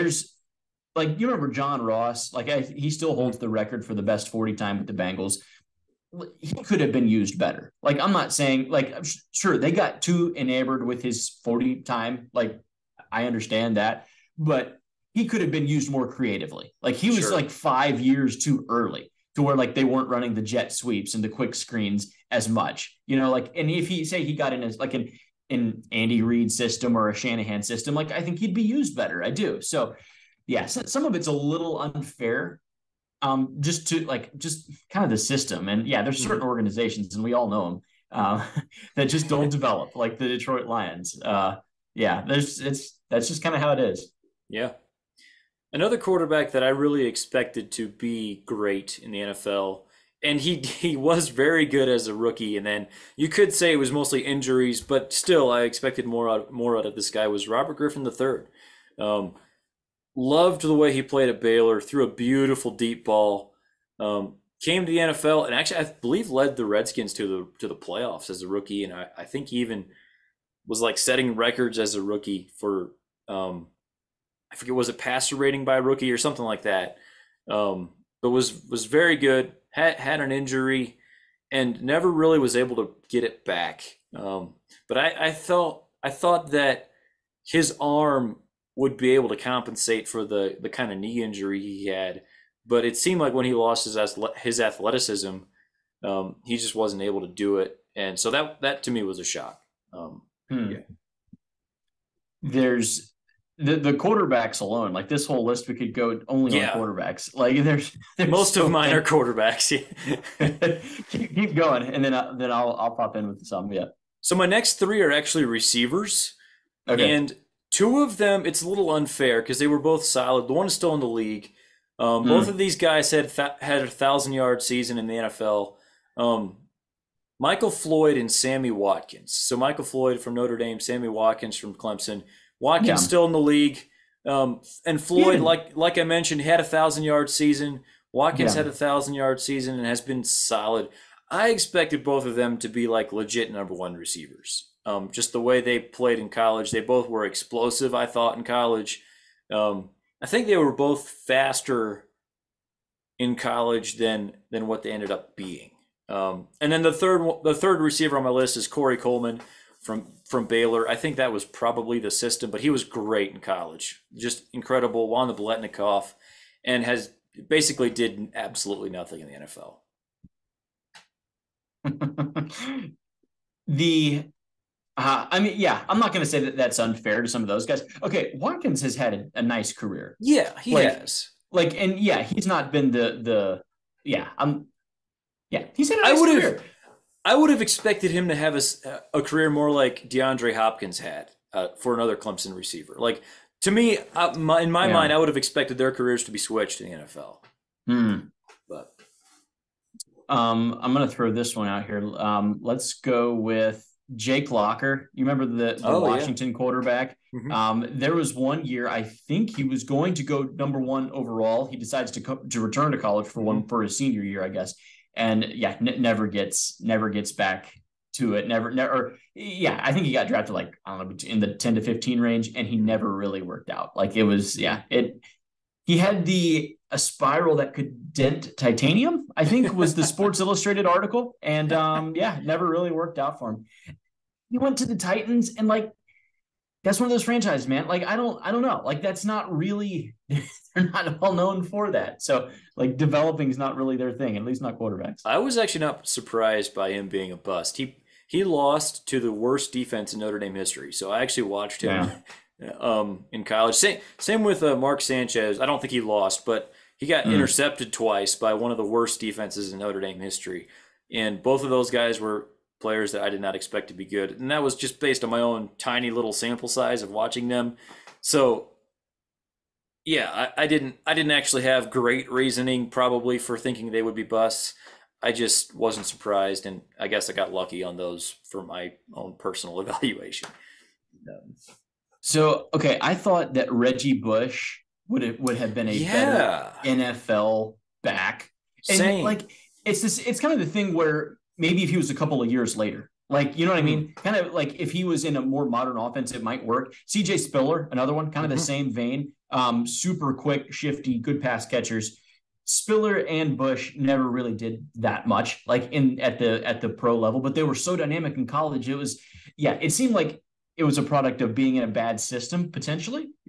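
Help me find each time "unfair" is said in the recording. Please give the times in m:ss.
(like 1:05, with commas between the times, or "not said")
0:31, 1:58, 2:56.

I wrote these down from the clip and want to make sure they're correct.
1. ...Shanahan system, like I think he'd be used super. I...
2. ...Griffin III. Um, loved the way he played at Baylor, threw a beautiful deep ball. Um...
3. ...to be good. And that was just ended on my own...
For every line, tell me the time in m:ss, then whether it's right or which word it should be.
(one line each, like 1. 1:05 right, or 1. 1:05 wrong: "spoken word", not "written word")
1. 0:27 wrong: "better", not "super"
2. 0:57 right
3. 4:23 wrong: "based", not "ended".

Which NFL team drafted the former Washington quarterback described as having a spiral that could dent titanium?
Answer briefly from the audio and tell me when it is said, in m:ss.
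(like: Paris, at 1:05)
Titans, at 3:54.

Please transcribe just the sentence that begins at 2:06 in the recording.
Um, Michael Floyd and Sammy Watkins.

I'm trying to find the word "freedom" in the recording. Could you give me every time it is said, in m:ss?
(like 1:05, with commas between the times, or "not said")
not said.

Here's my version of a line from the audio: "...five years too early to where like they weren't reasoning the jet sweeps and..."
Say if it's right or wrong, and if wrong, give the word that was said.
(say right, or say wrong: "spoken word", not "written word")
wrong: "running", not "reasoning".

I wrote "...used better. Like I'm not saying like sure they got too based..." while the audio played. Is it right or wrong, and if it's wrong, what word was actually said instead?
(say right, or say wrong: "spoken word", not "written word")
wrong: "enamored", not "based".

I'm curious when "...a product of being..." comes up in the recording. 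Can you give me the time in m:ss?
5:10.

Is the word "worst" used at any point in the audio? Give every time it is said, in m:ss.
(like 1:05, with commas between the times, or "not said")
4:09, 4:18.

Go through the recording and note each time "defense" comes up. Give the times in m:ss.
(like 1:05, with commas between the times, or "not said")
4:09, 4:19.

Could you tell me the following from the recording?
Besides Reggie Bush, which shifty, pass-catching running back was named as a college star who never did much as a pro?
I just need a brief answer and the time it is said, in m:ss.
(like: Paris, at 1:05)
CJ Spiller, at 4:57.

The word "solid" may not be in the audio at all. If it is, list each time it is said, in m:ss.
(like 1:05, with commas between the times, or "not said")
2:00, 2:20.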